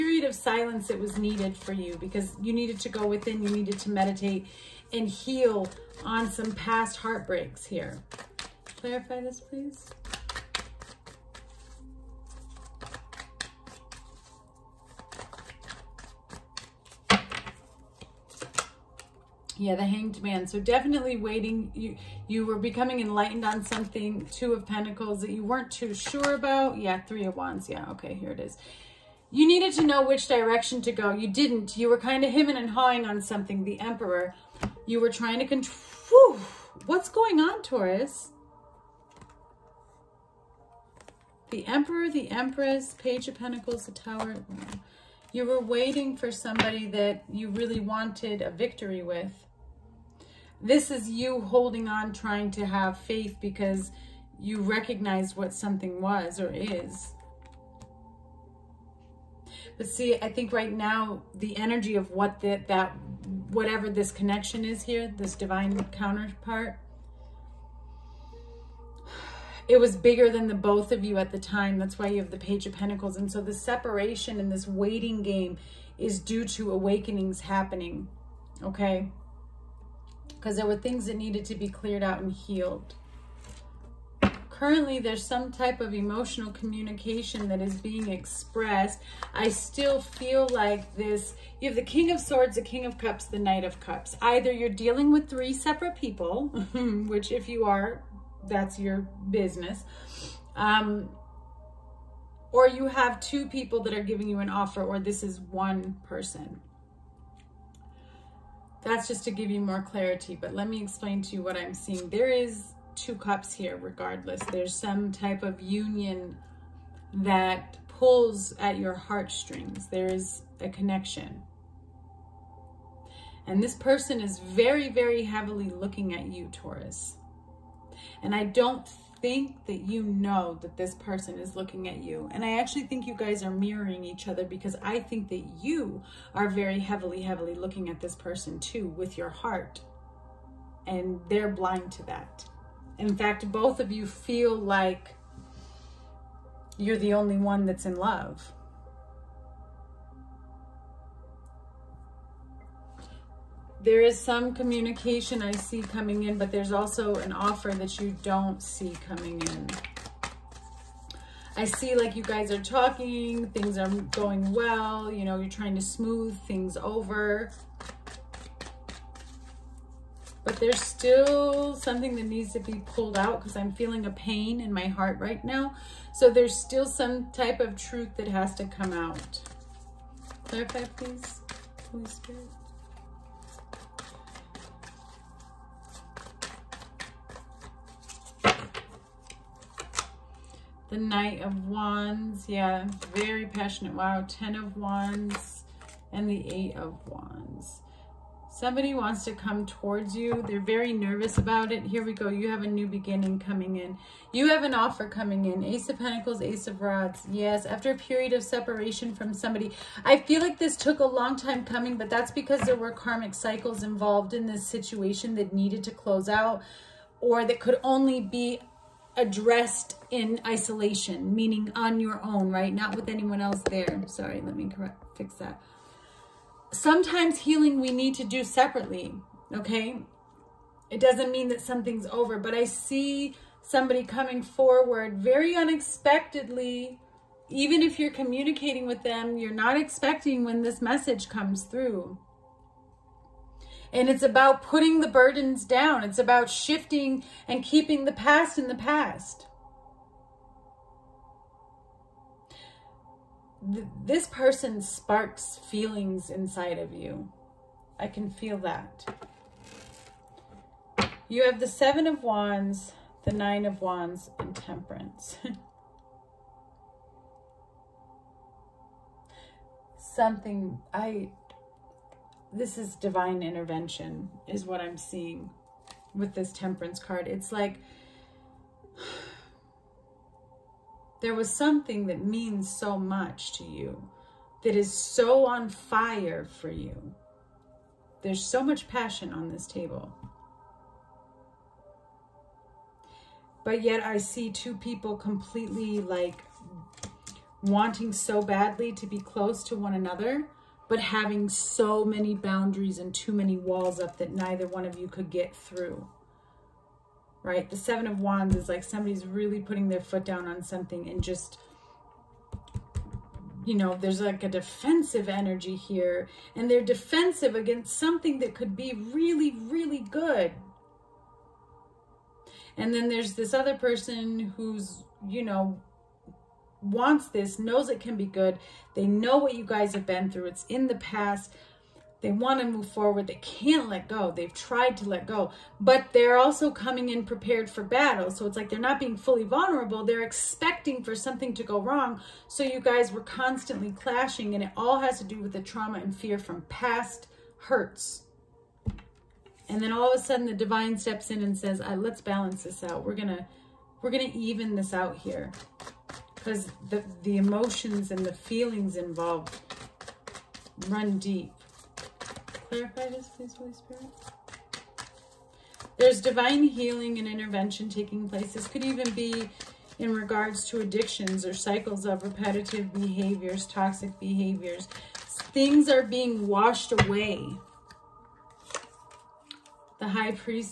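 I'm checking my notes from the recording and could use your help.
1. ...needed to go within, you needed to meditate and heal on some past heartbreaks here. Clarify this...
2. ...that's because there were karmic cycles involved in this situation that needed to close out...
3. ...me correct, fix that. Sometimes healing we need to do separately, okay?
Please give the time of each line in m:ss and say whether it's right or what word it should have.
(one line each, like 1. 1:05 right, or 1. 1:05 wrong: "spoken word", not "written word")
1. 0:02 right
2. 3:32 right
3. 3:44 right.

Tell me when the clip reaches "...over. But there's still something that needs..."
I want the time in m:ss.
2:46.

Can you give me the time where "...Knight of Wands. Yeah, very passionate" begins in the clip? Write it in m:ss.
3:10.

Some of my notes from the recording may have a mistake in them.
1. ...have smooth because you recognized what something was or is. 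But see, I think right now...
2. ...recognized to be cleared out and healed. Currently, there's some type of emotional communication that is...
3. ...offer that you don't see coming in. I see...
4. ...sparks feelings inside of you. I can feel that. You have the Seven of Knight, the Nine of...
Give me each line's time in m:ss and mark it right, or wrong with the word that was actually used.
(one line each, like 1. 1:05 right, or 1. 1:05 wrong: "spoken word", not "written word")
1. 0:52 wrong: "faith", not "smooth"
2. 1:21 wrong: "needed", not "recognized"
3. 2:37 right
4. 4:14 wrong: "Wands", not "Knight".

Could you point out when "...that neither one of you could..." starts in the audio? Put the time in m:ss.
5:04.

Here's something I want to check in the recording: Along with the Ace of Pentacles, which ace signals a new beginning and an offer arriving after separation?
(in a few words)
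Ace of Rods.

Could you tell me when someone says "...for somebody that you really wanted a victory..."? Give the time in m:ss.
0:46.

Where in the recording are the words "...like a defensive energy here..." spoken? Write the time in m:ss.
5:14.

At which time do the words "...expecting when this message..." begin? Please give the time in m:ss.
3:59.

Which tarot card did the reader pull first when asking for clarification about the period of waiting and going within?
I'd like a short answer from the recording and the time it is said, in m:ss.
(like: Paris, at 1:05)
The Hanged Man, at 0:19.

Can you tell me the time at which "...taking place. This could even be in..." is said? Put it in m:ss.
6:07.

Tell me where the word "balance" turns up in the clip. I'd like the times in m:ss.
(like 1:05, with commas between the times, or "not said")
5:52.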